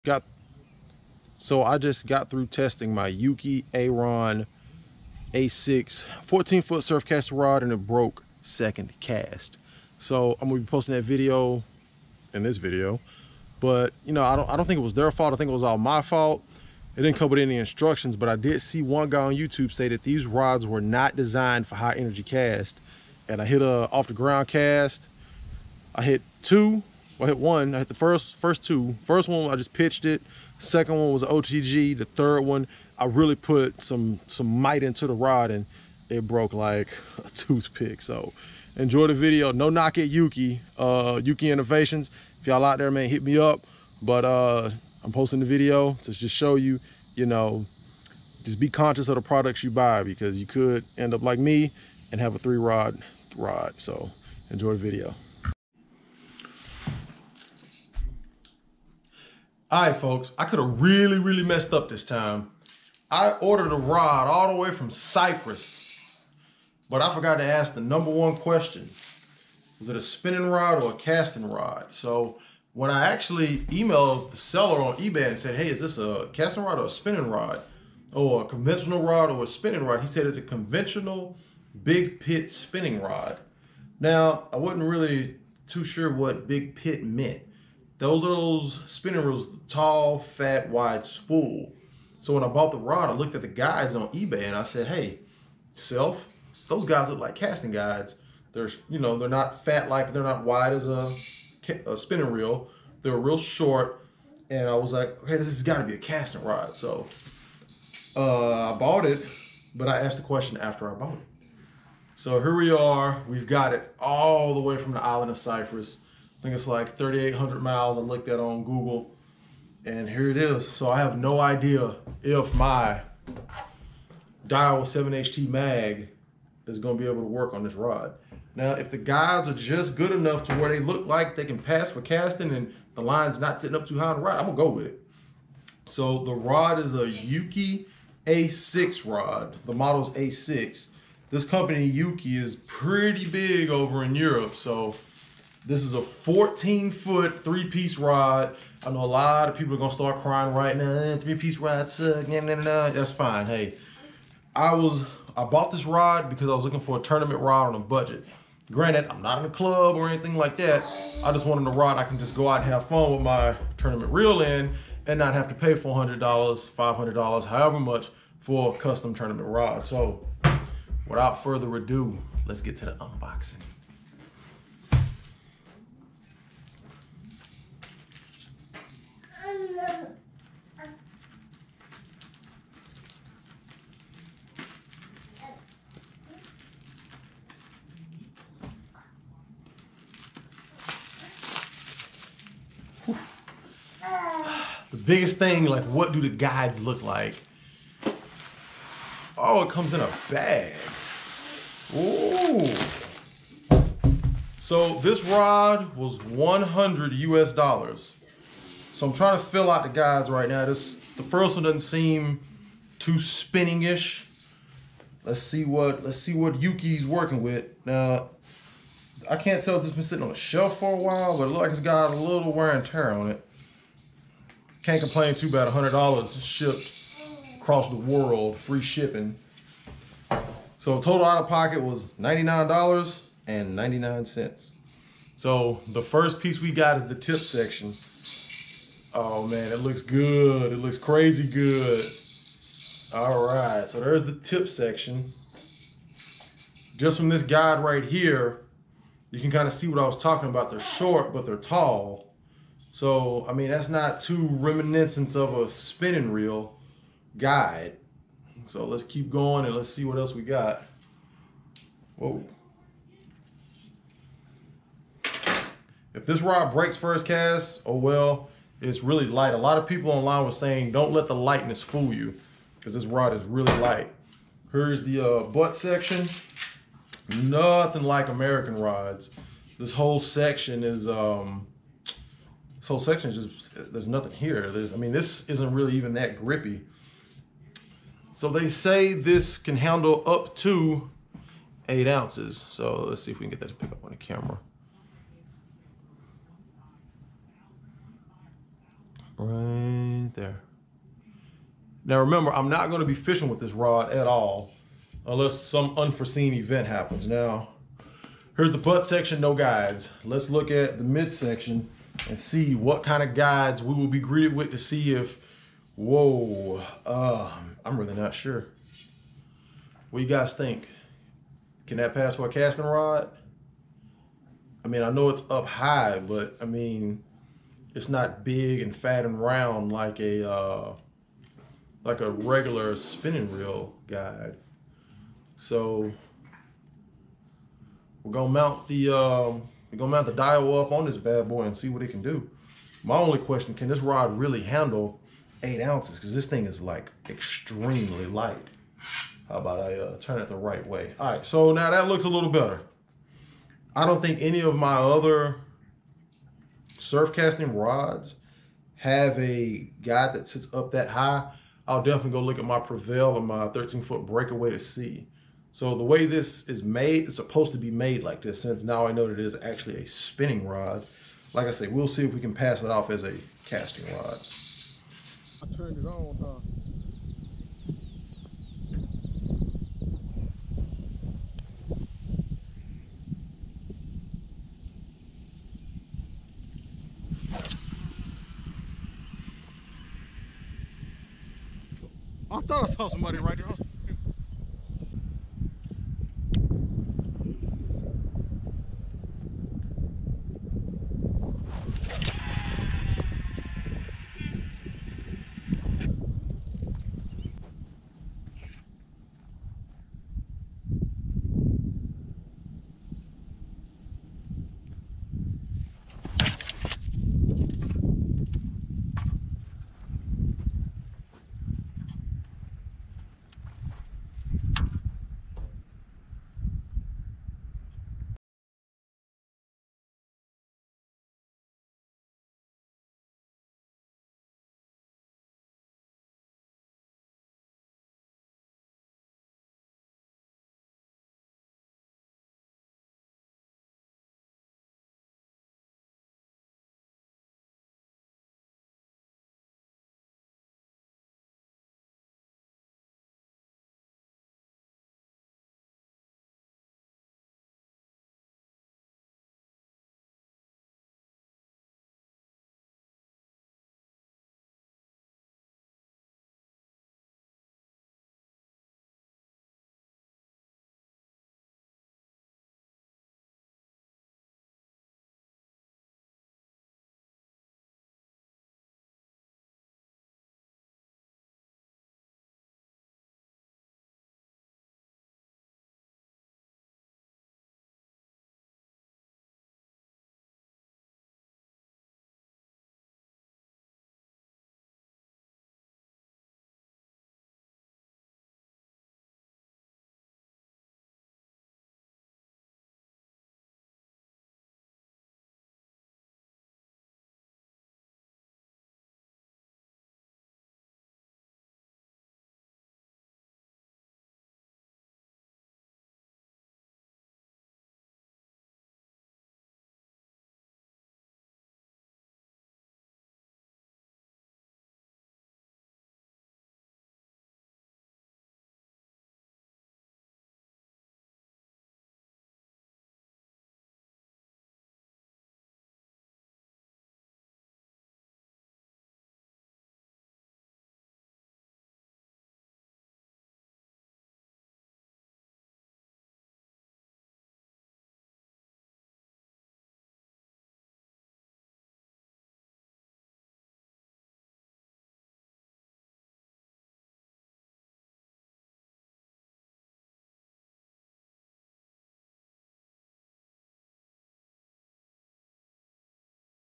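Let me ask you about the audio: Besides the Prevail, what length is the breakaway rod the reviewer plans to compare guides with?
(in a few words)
13 foot.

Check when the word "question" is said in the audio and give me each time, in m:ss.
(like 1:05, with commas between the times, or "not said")
1:08, 1:50, 5:43.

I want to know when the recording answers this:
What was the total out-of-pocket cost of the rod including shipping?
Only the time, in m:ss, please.
3:52.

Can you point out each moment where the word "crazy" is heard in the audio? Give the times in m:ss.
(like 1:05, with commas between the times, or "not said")
4:00.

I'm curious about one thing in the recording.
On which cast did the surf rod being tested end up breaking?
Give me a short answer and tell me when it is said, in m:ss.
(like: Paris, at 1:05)
Second cast, at 0:08.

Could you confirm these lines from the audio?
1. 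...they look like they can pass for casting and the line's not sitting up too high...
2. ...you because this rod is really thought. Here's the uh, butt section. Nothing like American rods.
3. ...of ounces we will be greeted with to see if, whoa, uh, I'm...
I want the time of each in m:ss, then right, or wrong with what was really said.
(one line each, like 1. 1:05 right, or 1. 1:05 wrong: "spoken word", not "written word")
1. 2:10 right
2. 4:32 wrong: "light", not "thought"
3. 5:13 wrong: "guides", not "ounces".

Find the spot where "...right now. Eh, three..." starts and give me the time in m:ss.
2:30.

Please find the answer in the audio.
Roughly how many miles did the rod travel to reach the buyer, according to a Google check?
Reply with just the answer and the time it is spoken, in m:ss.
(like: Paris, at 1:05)
3,800 miles, at 1:56.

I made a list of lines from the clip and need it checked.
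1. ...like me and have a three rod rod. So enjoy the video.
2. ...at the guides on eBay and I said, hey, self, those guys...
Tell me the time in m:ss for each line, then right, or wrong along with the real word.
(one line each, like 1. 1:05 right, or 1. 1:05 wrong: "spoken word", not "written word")
1. 0:51 right
2. 1:33 right.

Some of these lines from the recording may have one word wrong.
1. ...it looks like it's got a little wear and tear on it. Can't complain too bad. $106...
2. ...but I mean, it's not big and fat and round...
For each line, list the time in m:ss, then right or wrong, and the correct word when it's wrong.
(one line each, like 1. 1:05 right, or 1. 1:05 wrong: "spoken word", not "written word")
1. 3:41 wrong: "100", not "106"
2. 5:26 right.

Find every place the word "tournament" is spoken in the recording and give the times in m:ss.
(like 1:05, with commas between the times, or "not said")
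2:37, 2:43, 2:49.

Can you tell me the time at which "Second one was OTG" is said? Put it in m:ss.
0:30.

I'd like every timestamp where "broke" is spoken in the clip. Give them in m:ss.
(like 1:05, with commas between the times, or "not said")
0:07, 0:36.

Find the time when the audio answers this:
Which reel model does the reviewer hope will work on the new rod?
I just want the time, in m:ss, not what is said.
2:04.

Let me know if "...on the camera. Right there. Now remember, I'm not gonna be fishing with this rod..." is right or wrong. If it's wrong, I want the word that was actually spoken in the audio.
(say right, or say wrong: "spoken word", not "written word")
right.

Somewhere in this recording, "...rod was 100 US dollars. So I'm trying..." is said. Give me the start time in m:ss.
3:25.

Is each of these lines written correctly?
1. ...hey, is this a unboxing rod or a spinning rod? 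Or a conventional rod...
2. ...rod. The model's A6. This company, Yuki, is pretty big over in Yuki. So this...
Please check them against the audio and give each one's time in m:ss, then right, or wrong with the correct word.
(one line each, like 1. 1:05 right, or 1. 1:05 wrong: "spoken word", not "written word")
1. 1:15 wrong: "casting", not "unboxing"
2. 2:19 wrong: "Europe", not "Yuki".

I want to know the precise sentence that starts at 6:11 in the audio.
Like I say, we'll see if we can pass it off as a casting rod.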